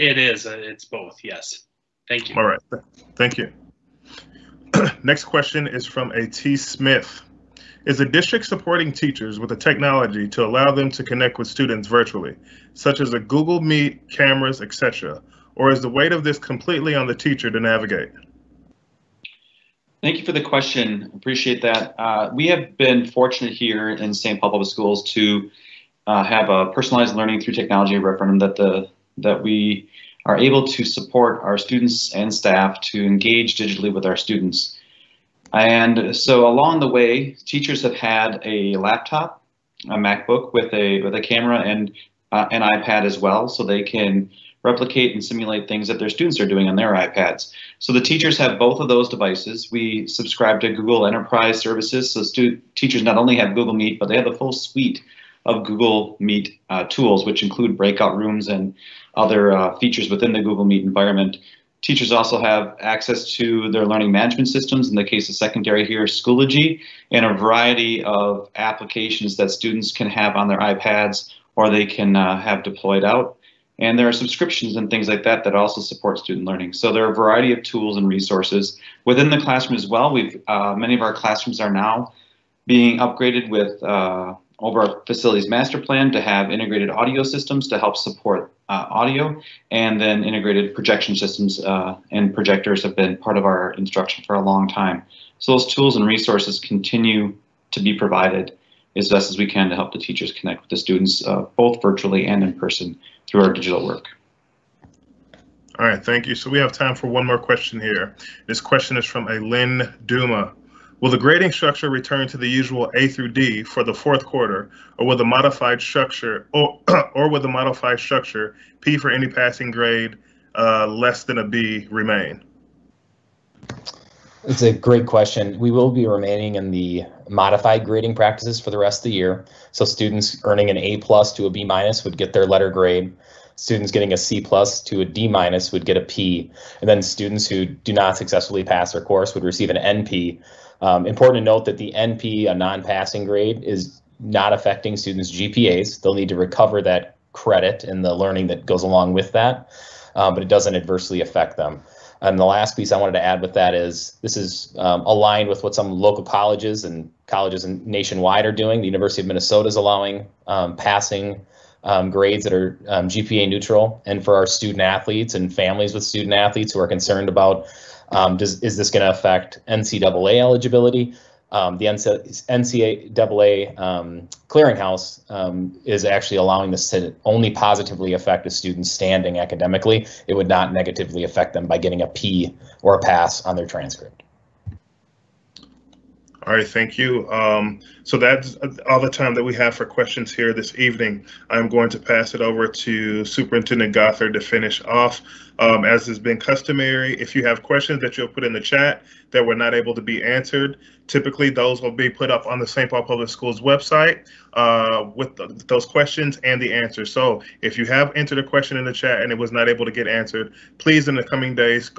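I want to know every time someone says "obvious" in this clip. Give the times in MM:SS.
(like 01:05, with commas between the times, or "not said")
not said.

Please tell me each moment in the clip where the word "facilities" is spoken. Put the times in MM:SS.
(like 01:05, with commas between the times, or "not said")
01:25.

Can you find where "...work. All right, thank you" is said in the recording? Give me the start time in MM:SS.
01:43.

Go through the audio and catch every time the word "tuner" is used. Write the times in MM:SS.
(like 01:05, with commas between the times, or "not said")
not said.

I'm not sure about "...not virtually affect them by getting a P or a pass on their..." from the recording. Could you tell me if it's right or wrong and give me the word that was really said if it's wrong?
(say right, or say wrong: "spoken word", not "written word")
wrong: "negatively", not "virtually".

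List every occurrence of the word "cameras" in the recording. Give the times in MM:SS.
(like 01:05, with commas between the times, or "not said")
00:14, 00:41.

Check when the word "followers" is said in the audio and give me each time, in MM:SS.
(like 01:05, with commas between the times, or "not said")
not said.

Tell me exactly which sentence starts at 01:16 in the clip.
So there are a variety of tools and resources within the classroom as well.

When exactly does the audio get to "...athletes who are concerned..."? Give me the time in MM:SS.
02:46.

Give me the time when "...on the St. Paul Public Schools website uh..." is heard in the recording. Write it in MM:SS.
03:22.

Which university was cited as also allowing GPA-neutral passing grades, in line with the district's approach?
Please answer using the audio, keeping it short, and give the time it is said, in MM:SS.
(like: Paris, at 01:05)
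University of Minnesota, at 02:38.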